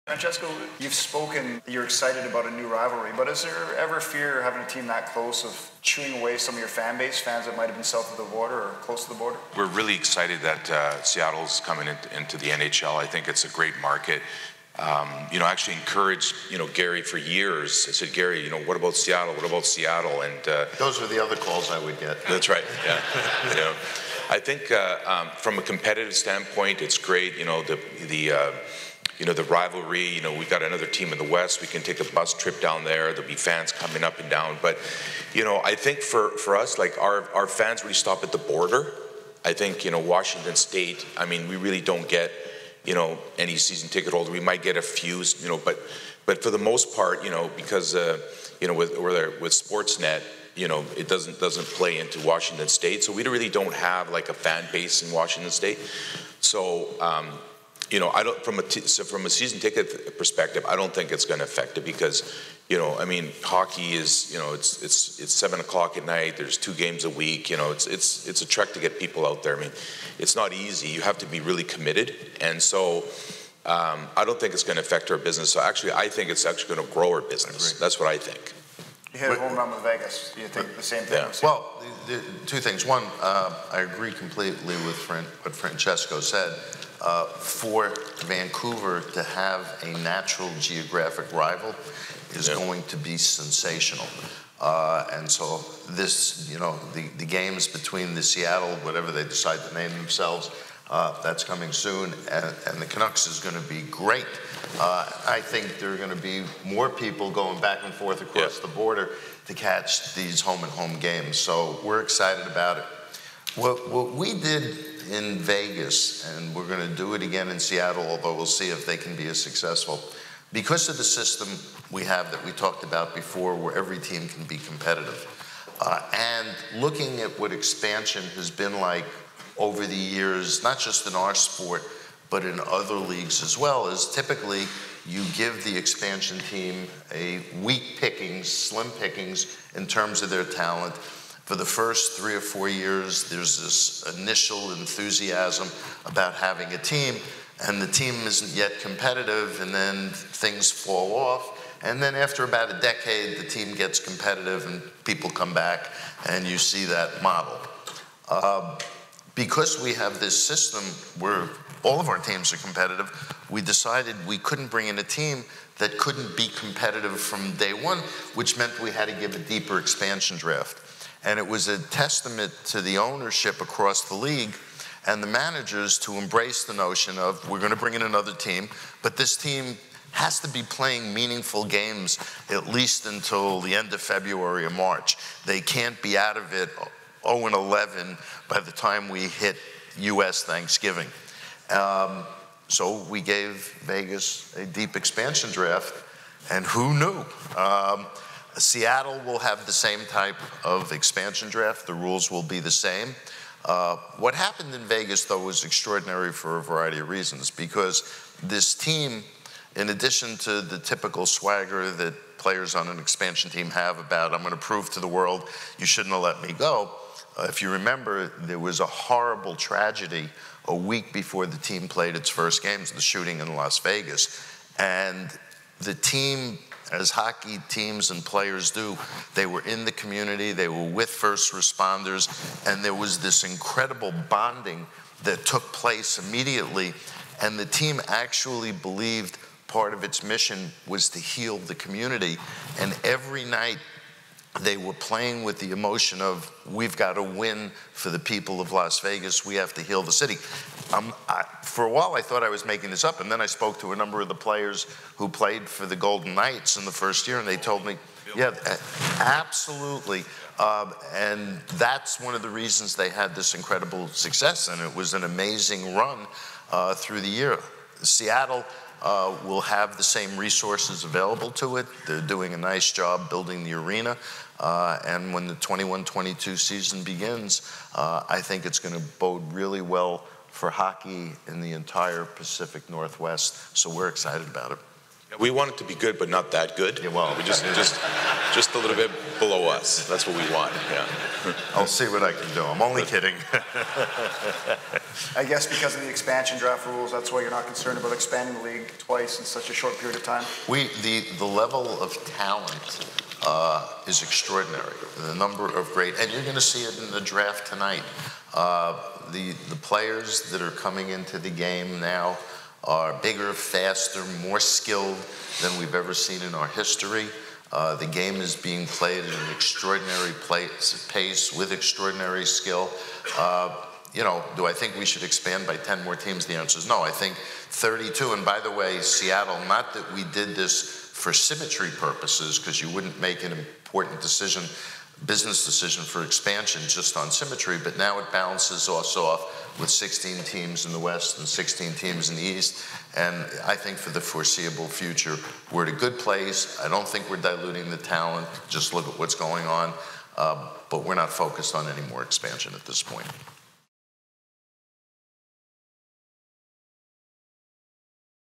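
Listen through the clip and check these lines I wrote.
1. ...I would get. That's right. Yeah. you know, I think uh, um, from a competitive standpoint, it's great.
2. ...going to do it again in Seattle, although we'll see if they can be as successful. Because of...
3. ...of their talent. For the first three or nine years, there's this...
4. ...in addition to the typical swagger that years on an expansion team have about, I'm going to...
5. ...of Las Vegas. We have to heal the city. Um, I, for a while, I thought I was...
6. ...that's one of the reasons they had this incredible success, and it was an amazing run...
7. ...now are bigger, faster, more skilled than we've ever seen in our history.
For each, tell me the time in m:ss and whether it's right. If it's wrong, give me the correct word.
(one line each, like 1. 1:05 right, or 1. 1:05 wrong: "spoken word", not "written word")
1. 0:21 right
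2. 1:56 right
3. 2:20 wrong: "four", not "nine"
4. 3:29 wrong: "players", not "years"
5. 4:08 right
6. 4:21 right
7. 5:12 right.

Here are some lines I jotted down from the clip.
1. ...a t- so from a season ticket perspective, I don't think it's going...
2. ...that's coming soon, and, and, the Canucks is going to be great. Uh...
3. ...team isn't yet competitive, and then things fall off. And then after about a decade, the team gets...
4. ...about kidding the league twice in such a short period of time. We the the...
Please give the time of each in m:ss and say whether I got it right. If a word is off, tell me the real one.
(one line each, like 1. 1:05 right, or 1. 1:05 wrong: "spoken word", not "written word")
1. 0:58 right
2. 1:41 right
3. 2:27 right
4. 4:57 wrong: "expanding", not "kidding".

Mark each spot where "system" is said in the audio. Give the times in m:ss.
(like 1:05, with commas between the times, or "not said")
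2:01, 2:40.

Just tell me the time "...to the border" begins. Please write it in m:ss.
0:09.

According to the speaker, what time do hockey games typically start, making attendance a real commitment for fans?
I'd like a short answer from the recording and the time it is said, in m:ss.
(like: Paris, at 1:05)
7 o'clock at night, at 1:05.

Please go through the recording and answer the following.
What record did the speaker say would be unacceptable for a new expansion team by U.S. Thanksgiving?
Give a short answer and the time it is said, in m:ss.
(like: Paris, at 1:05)
0 and 11, at 3:07.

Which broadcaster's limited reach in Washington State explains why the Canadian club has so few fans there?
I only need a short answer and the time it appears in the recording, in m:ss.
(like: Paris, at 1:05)
Sportsnet, at 0:49.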